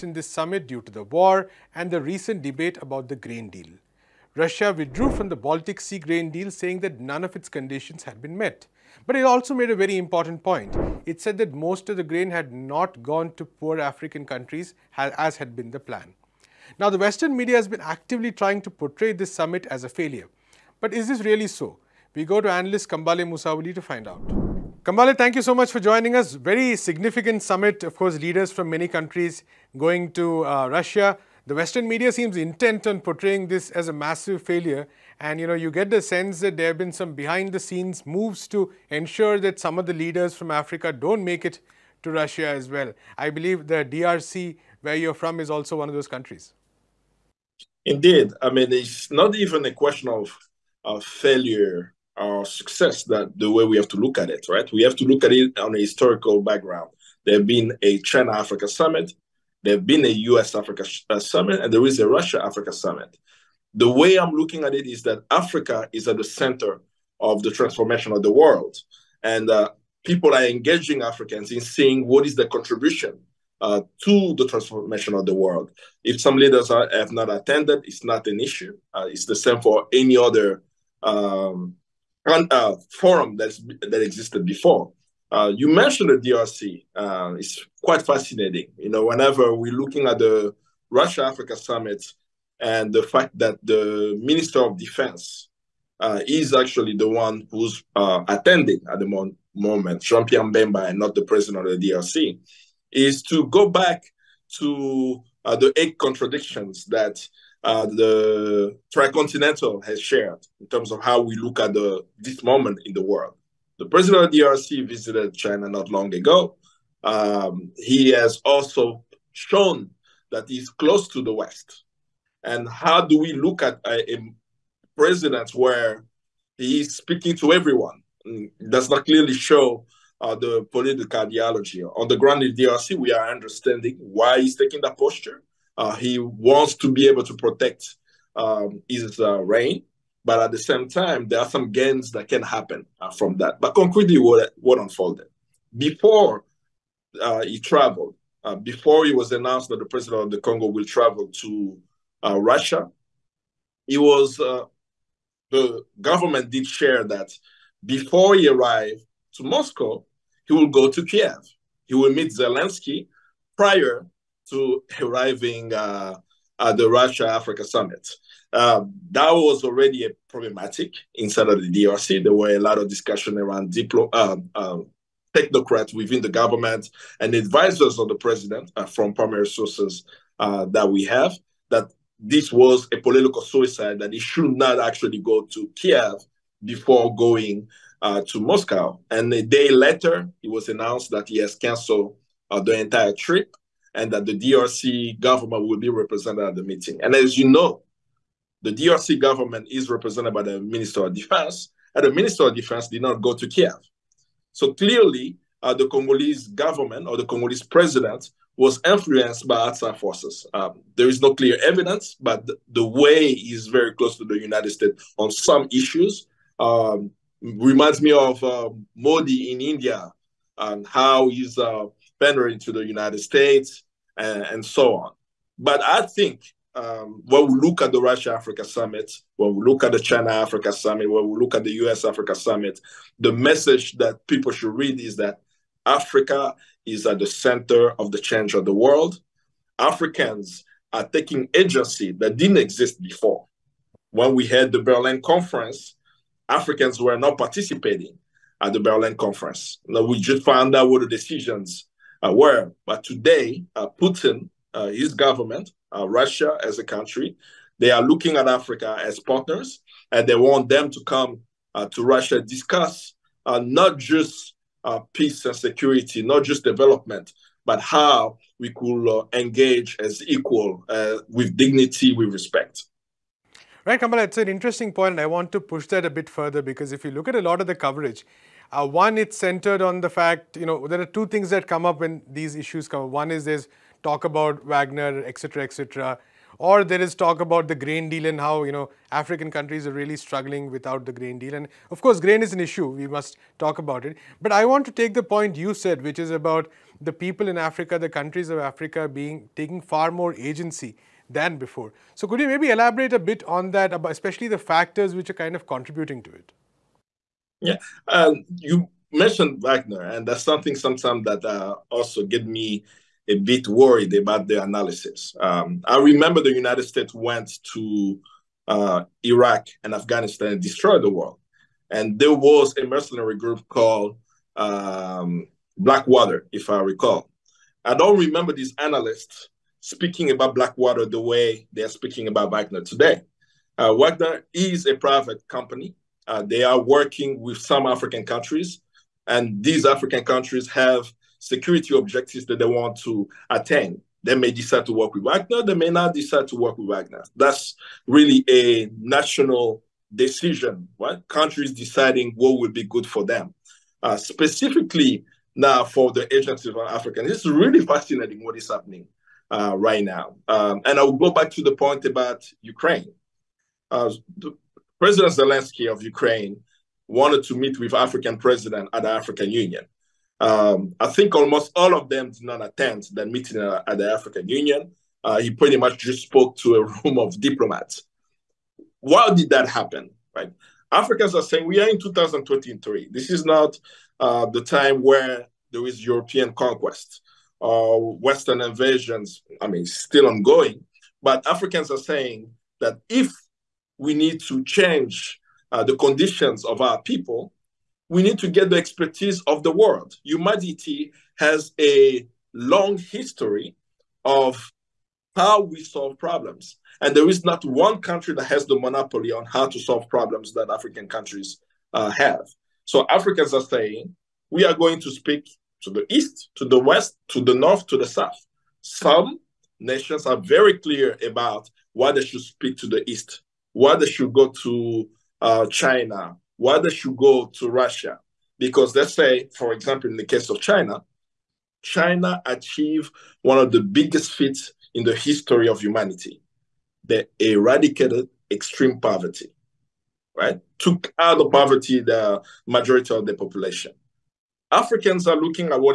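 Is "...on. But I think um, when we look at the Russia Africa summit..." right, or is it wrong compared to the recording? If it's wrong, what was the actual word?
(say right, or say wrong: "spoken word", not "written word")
right.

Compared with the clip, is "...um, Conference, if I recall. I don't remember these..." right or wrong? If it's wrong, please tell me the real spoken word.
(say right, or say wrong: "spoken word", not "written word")
wrong: "Blackwater", not "Conference".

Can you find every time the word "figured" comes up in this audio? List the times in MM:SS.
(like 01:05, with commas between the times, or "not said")
not said.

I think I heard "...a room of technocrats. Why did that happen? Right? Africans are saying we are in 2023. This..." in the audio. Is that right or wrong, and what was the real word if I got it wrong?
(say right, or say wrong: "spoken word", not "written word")
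wrong: "diplomats", not "technocrats".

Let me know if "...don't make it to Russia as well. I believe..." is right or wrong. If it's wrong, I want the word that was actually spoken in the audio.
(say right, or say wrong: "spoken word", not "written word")
right.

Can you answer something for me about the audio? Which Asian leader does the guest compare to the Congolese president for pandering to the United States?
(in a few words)
Modi.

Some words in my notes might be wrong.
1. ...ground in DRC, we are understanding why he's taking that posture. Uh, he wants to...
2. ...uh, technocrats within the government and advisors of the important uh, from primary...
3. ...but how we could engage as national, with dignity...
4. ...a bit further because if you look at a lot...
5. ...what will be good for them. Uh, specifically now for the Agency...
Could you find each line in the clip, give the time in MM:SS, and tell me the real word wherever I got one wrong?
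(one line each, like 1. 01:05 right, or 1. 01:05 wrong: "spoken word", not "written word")
1. 02:12 right
2. 02:54 wrong: "president", not "important"
3. 04:27 wrong: "equal", not "national"
4. 04:36 right
5. 05:52 right.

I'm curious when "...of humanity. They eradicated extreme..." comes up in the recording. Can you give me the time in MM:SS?
07:15.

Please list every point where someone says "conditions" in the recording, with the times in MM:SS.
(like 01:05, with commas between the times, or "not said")
00:07, 06:35.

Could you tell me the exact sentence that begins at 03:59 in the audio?
Africans are taking agency that didn't exist before.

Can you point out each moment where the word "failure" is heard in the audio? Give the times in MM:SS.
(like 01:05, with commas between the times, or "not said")
00:19, 00:34, 00:51.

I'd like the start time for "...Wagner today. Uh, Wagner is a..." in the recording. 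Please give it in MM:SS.
05:32.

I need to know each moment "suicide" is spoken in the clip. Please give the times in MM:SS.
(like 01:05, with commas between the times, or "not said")
03:03.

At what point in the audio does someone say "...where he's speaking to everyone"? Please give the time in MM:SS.
02:05.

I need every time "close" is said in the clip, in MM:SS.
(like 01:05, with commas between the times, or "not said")
02:00, 03:33.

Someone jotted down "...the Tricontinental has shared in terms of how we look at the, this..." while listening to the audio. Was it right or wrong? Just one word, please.
right.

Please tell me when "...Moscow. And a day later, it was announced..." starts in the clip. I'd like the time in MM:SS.
03:08.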